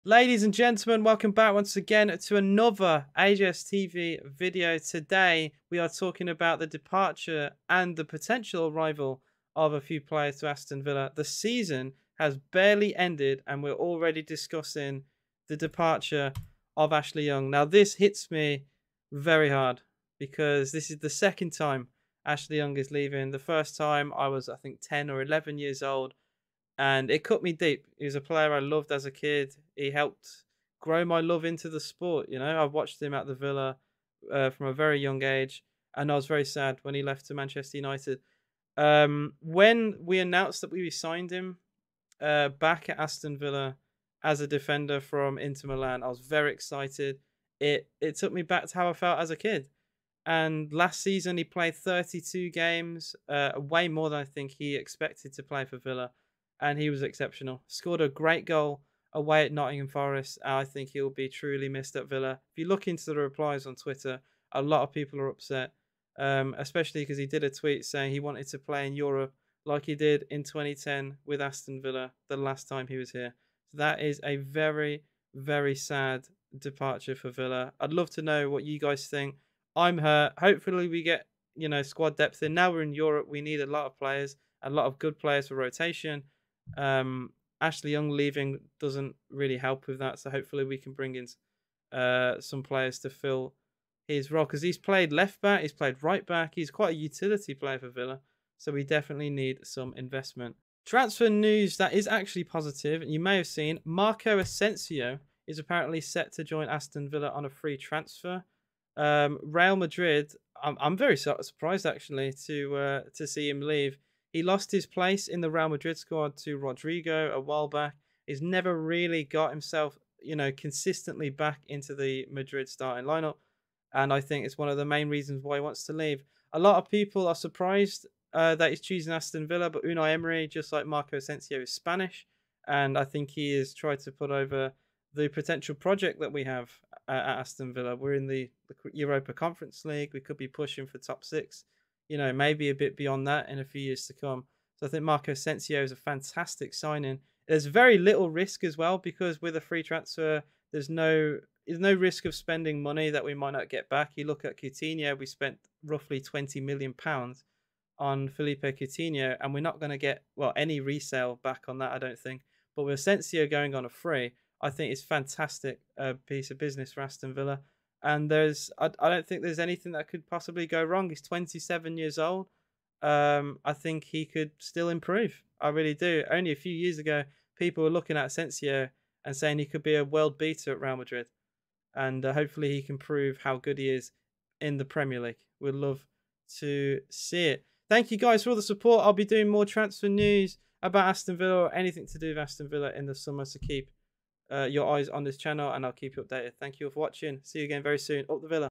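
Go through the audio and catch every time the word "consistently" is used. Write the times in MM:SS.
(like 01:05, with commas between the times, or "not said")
02:00.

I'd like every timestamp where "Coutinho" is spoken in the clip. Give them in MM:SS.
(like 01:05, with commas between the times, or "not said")
02:34, 02:38.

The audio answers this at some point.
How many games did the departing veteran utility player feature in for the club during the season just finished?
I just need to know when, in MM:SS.
00:51.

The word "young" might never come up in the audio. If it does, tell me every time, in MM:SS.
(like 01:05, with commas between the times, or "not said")
00:17, 00:22, 00:34, 01:27.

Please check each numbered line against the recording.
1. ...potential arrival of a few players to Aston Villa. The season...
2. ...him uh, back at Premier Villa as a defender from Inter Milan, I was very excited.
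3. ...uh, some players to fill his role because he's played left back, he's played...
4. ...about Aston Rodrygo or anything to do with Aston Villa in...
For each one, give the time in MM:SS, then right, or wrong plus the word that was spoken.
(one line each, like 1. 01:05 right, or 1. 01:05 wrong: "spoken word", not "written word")
1. 00:08 right
2. 00:41 wrong: "Aston", not "Premier"
3. 01:31 right
4. 03:10 wrong: "Villa", not "Rodrygo".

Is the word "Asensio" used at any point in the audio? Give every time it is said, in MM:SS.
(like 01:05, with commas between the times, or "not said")
01:44, 02:11, 02:25, 02:42, 02:58.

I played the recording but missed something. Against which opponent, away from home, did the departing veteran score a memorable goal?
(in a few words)
Nottingham Forest.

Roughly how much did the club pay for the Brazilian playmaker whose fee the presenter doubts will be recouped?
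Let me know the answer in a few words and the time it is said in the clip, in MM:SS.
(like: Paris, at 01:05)
£20 million, at 02:36.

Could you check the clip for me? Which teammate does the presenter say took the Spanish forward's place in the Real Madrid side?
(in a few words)
Rodrygo.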